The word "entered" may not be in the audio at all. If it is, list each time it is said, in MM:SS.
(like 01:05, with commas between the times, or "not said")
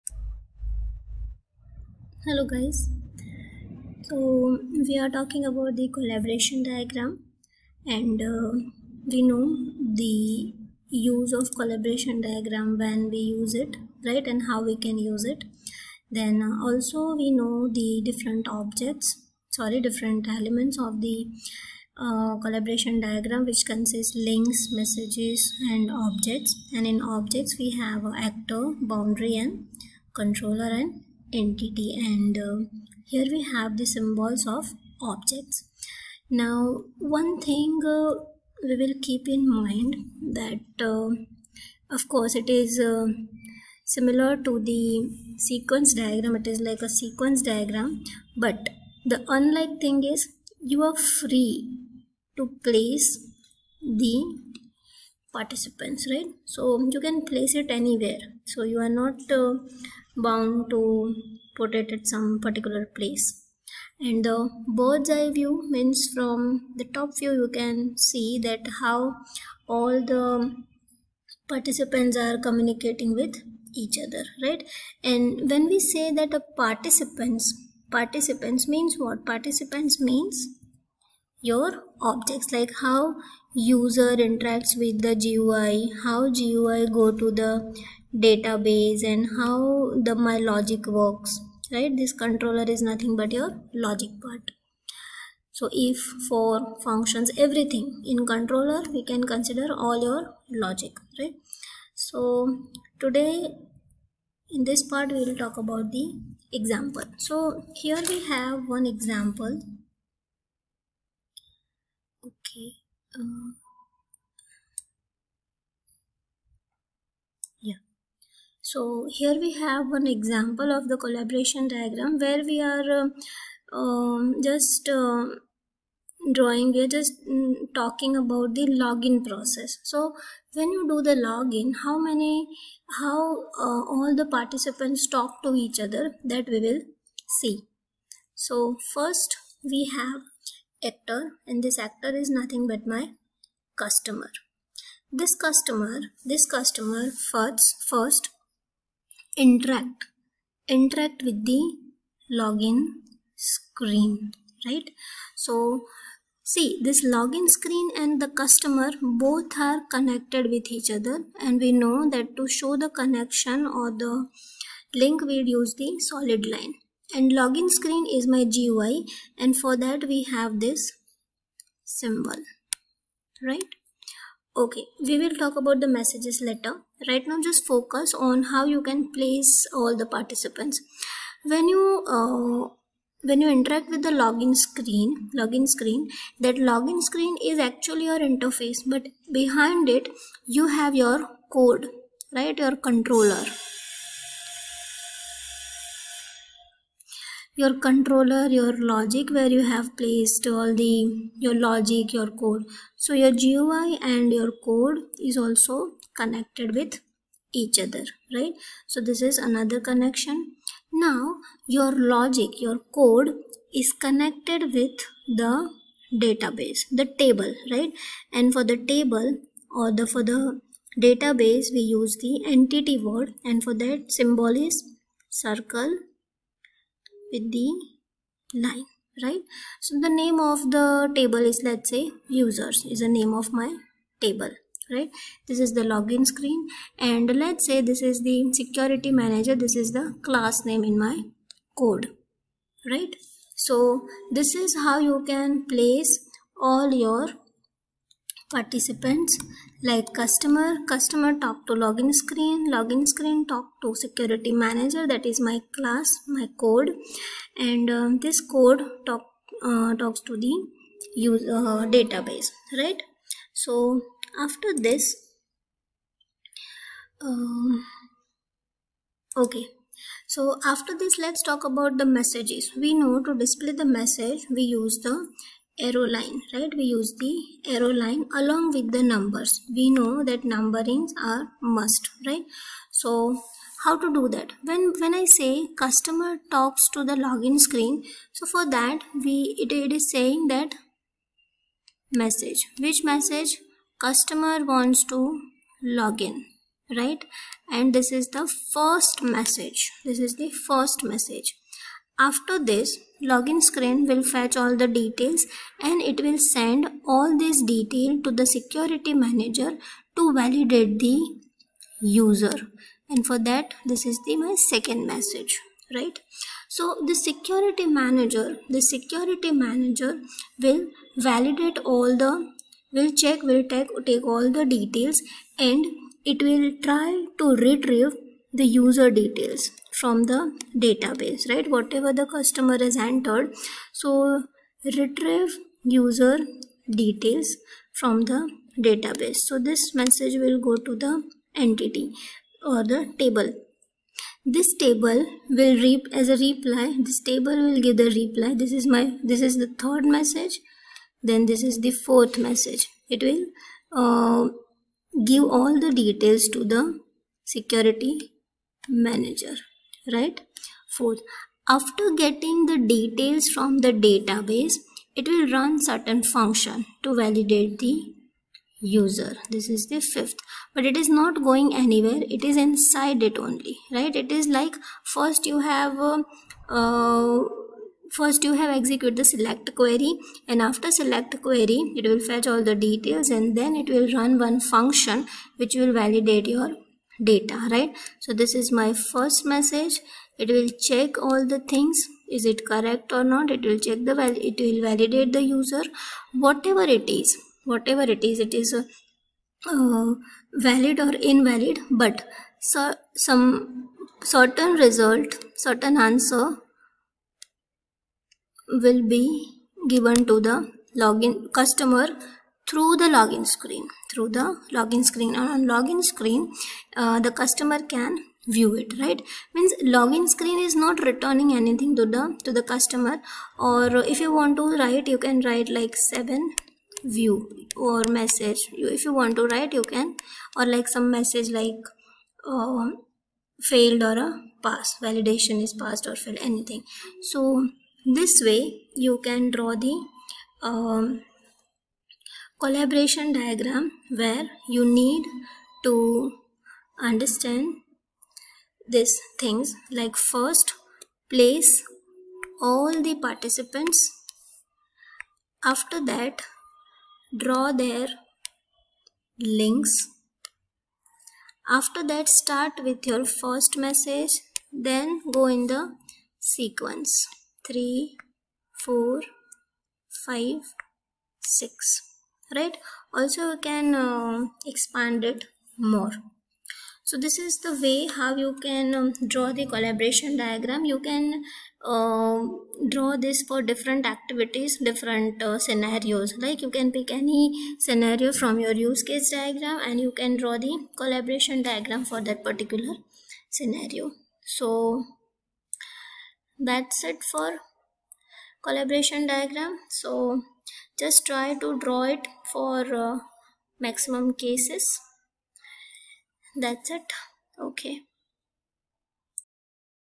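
05:33.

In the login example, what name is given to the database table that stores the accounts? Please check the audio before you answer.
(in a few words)
users.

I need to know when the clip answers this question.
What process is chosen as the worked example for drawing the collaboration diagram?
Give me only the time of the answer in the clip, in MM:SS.
02:08.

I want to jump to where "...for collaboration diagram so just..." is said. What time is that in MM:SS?
08:17.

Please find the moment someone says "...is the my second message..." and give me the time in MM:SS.
05:14.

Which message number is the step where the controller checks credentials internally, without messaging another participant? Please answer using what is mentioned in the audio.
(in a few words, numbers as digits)
5.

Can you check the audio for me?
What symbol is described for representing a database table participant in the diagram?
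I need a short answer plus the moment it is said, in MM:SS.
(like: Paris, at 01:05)
circle with the line, at 03:45.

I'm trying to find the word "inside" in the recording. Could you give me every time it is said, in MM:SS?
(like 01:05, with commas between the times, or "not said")
06:12.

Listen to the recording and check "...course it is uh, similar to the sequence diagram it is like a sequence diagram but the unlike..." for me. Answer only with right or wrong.
right.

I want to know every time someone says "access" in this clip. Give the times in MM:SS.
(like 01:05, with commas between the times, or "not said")
not said.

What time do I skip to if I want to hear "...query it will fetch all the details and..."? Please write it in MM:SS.
06:21.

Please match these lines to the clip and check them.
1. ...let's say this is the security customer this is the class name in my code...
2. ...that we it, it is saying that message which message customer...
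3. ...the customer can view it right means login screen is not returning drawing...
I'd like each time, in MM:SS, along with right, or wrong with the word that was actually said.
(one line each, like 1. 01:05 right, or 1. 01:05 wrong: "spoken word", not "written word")
1. 03:57 wrong: "manager", not "customer"
2. 04:48 right
3. 06:57 wrong: "anything", not "drawing".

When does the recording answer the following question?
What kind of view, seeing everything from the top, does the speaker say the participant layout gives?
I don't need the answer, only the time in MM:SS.
01:04.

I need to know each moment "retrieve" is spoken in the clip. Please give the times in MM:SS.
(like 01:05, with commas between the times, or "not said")
05:27, 05:34.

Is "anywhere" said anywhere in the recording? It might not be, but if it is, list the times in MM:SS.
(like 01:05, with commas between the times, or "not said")
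00:57, 06:11.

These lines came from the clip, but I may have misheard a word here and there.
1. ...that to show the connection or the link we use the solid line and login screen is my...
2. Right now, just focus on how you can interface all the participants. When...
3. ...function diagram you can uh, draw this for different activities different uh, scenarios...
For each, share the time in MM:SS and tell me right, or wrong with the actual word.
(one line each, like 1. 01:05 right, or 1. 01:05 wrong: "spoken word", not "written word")
1. 02:42 right
2. 02:57 wrong: "place", not "interface"
3. 07:59 wrong: "collaboration", not "function".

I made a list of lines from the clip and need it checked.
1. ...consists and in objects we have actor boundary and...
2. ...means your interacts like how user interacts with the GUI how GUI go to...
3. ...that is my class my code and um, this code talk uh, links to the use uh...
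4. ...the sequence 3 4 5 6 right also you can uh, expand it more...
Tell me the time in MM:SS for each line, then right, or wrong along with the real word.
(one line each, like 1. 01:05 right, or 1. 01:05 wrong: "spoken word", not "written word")
1. 00:26 wrong: "objects", not "consists"
2. 01:20 wrong: "objects", not "interacts"
3. 04:15 wrong: "talks", not "links"
4. 07:45 right.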